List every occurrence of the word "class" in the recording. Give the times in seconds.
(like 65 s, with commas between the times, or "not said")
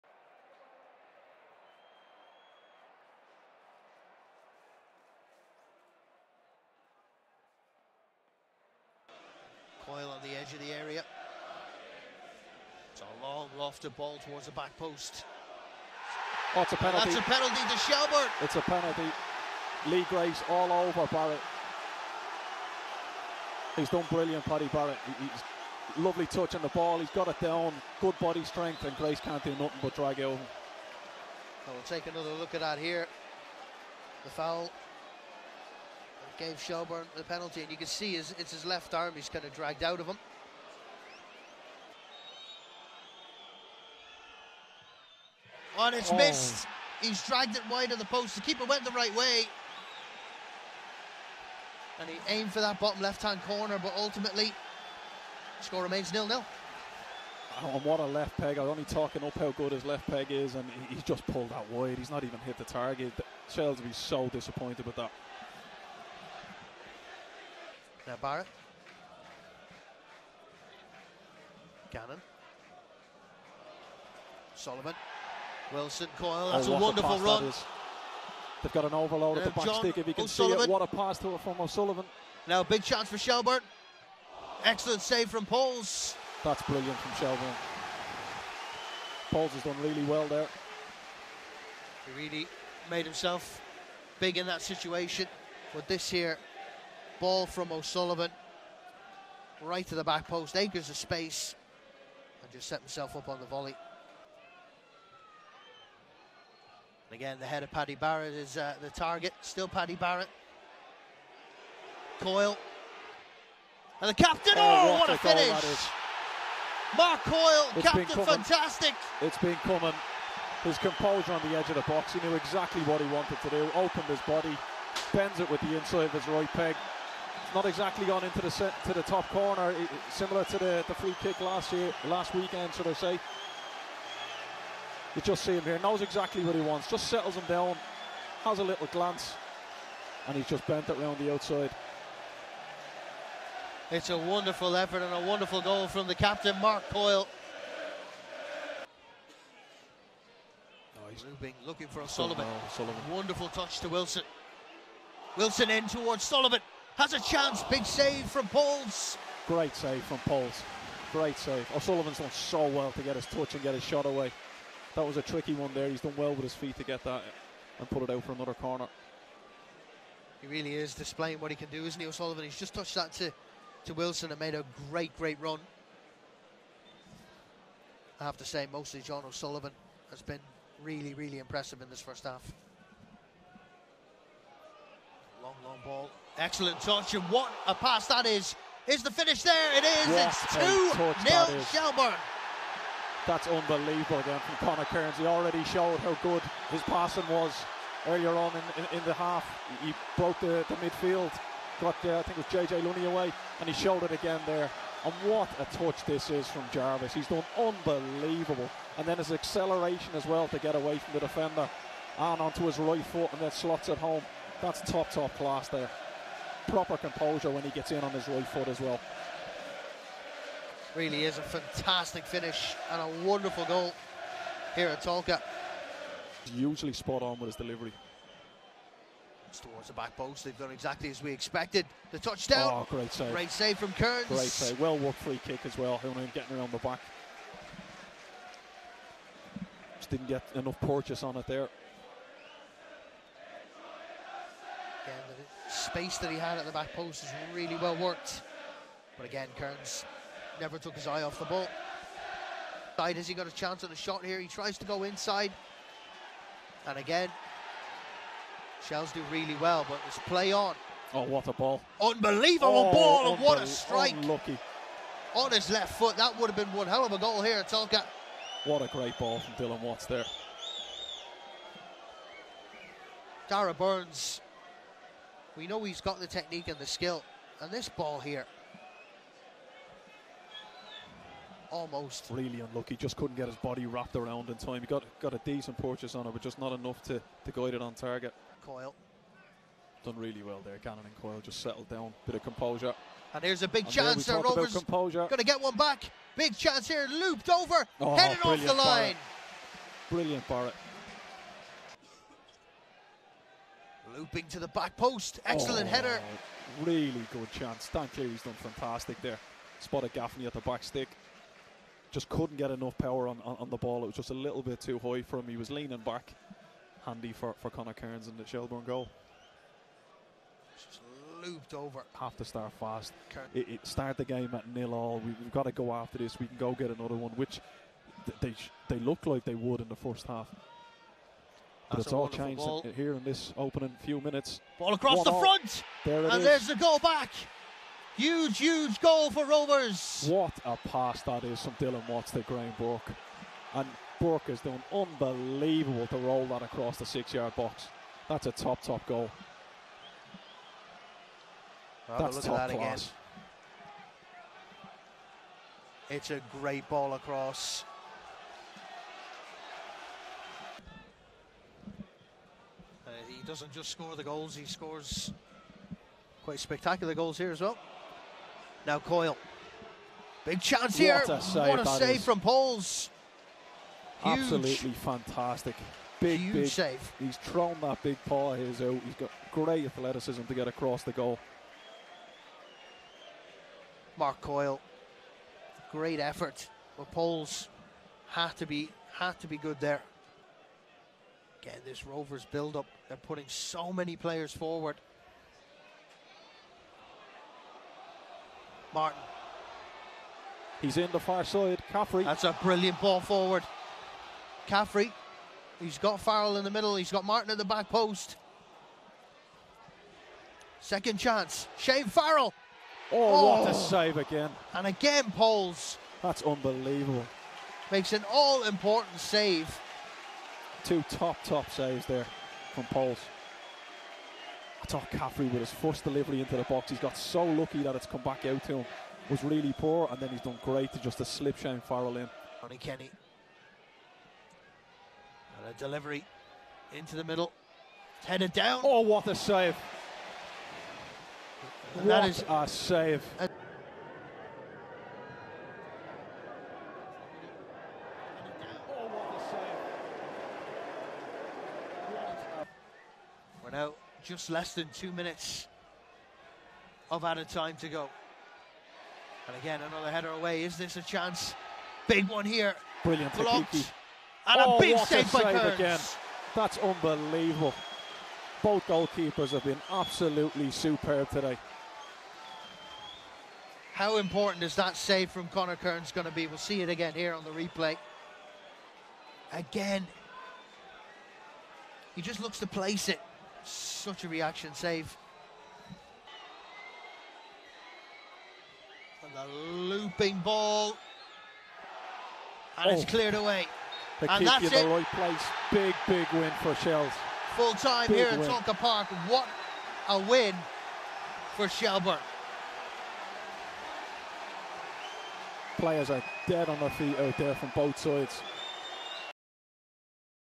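215 s, 352 s.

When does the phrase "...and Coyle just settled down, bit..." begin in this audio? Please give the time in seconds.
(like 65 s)
291 s.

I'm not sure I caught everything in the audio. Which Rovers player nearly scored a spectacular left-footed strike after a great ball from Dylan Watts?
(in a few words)
Darragh Burns.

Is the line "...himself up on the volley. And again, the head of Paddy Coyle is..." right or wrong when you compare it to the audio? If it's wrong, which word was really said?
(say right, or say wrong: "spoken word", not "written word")
wrong: "Barrett", not "Coyle".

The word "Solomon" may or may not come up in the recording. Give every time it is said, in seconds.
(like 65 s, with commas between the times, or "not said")
74 s.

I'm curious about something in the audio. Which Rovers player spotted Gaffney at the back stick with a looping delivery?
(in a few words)
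Dan Cleary.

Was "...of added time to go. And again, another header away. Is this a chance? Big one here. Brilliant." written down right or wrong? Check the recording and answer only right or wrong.
right.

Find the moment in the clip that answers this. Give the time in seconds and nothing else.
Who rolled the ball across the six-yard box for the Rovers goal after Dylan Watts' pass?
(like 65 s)
342 s.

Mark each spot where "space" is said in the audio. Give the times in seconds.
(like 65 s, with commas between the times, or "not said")
100 s, 245 s.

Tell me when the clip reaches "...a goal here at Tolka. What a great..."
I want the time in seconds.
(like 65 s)
267 s.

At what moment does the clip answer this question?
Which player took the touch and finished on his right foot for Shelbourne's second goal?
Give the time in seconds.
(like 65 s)
206 s.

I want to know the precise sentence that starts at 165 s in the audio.
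He's done well with his feet to get that and put it out for another corner.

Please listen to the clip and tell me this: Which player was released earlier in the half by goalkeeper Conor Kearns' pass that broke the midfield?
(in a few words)
JJ Lunney.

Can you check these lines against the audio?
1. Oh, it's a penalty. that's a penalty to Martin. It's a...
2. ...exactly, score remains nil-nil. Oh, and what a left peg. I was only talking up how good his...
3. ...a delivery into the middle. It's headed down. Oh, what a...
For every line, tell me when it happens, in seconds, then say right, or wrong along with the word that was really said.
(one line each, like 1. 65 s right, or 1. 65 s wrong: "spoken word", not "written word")
1. 16 s wrong: "Shelbourne", not "Martin"
2. 53 s wrong: "ultimately", not "exactly"
3. 435 s right.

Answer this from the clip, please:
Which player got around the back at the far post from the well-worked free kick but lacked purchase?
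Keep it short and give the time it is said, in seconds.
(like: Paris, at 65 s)
Honohan, at 235 s.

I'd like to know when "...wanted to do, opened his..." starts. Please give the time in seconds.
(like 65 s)
123 s.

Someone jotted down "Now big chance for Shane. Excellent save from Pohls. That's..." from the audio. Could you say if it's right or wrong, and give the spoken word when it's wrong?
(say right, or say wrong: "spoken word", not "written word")
wrong: "Shelbourne", not "Shane".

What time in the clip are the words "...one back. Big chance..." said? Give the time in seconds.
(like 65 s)
295 s.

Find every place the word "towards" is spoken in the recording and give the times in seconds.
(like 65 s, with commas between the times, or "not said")
14 s, 155 s, 229 s.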